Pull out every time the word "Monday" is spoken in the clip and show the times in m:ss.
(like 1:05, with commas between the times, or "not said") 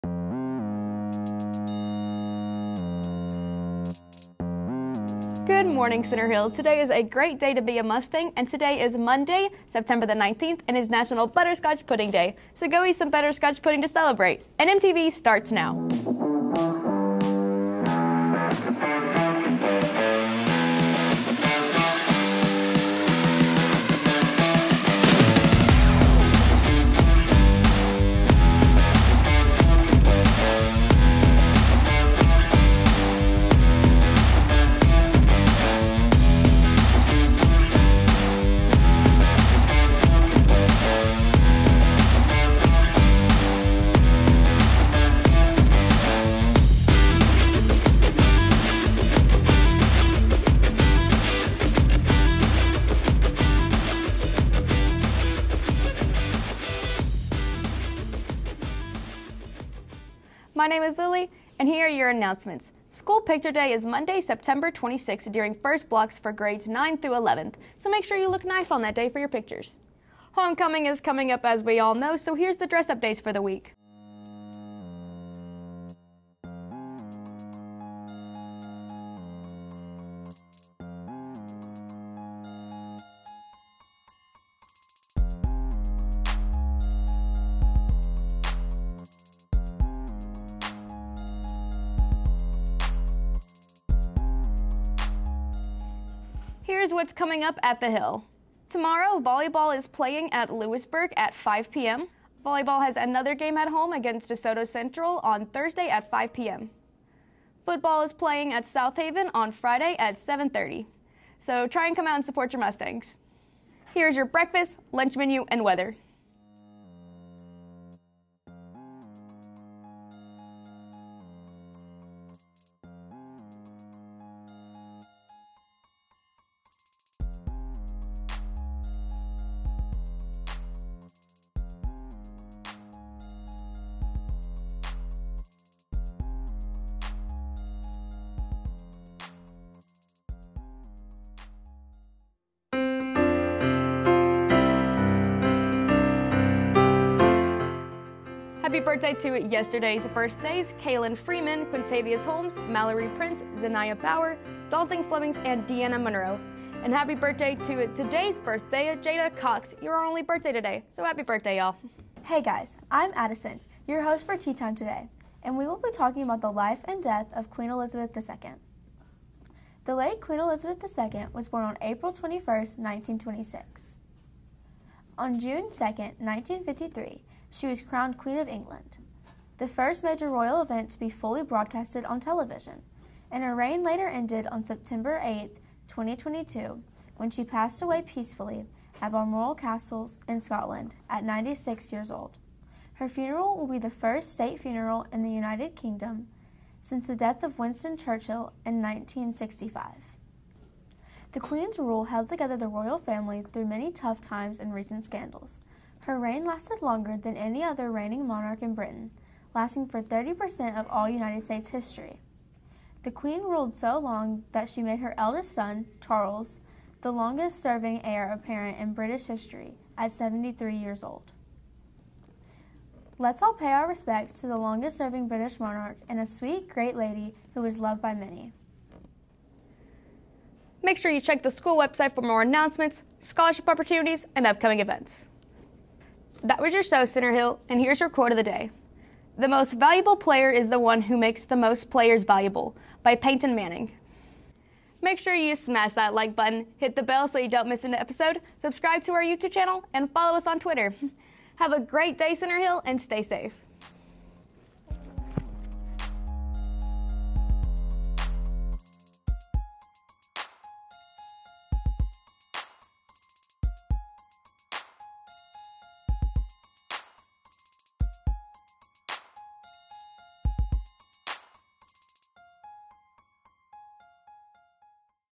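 0:08, 1:03.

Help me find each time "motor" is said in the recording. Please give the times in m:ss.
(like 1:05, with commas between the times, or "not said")
not said.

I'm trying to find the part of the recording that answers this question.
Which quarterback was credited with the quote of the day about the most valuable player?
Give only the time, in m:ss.
4:03.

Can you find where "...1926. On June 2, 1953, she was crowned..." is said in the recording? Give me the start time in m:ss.
2:52.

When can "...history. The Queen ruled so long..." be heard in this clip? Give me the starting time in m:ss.
3:31.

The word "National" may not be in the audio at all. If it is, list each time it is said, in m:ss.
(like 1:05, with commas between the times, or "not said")
0:10.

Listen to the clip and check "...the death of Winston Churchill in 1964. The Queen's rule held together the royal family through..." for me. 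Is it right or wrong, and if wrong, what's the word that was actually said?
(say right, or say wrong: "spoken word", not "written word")
wrong: "1965", not "1964".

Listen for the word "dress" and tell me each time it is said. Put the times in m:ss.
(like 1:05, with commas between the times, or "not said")
1:12.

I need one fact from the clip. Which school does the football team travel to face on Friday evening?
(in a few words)
Southaven.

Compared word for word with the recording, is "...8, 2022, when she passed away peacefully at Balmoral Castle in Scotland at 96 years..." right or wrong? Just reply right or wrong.
right.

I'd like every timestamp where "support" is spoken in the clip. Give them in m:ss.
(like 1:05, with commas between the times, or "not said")
1:52.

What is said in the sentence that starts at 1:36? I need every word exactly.
Here's what's coming up at the Hill.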